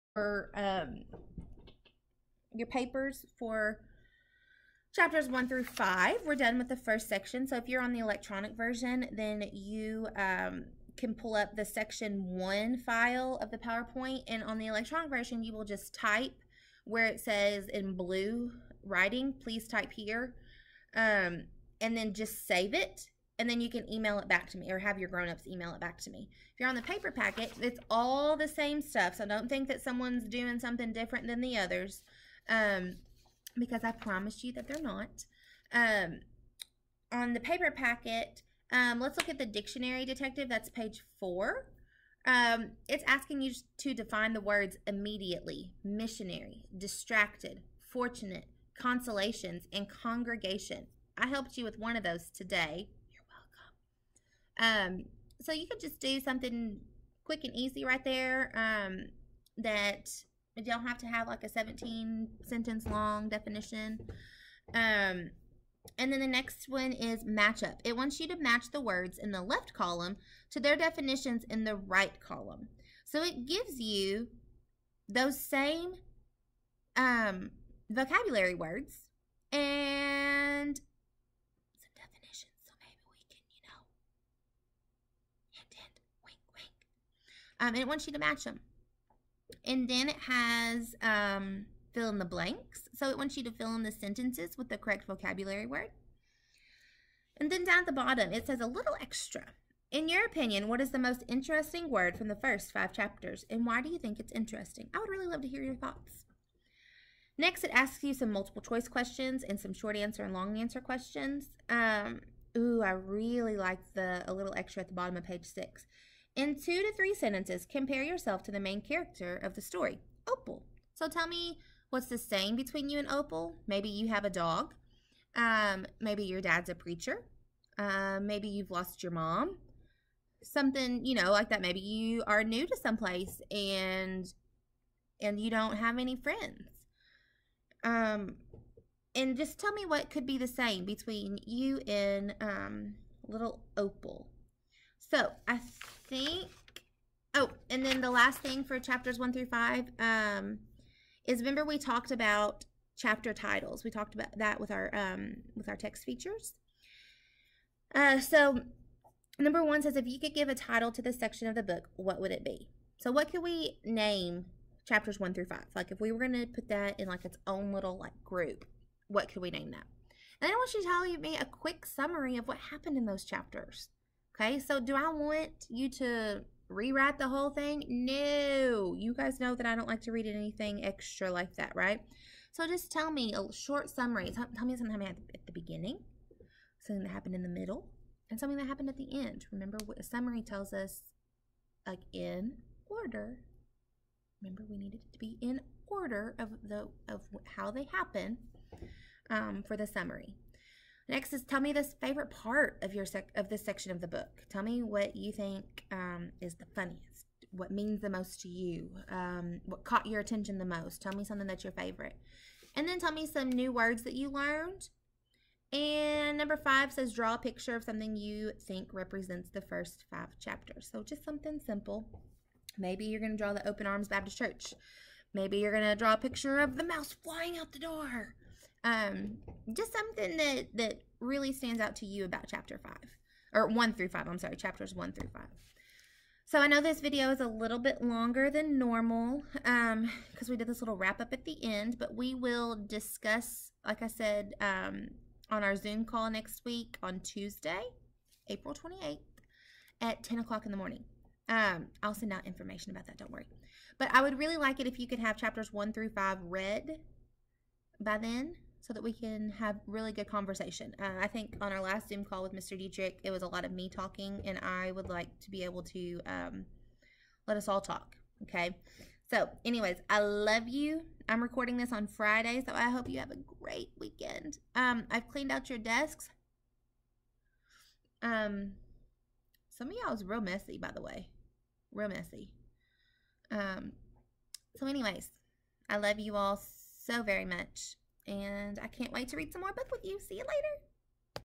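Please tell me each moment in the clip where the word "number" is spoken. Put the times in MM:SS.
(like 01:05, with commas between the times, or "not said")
02:39, 03:36.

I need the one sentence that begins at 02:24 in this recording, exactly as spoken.
So I think, oh, and then the last thing for chapters one through five um, is remember we talked about chapter titles.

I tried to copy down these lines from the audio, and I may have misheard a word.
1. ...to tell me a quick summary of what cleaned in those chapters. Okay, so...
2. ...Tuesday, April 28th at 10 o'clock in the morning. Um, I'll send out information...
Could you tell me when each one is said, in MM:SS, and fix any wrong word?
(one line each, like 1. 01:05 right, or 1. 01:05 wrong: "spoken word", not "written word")
1. 02:50 wrong: "happened", not "cleaned"
2. 04:07 right.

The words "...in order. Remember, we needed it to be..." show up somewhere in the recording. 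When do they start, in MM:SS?
03:12.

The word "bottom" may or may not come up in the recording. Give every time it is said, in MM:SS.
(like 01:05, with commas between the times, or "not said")
01:37, 01:54.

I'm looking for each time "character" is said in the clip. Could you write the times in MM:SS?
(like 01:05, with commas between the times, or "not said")
01:58.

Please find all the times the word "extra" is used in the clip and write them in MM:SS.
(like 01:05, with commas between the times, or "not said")
01:38, 01:54, 03:00.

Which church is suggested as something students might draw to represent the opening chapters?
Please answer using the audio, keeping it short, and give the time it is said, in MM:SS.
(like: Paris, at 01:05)
Open Arms Baptist Church, at 03:43.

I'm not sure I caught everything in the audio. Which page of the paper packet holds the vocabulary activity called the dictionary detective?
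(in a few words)
4.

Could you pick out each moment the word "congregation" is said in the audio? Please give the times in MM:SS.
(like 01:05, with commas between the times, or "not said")
00:49.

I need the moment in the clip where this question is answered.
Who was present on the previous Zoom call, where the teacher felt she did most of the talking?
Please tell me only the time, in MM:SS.
04:22.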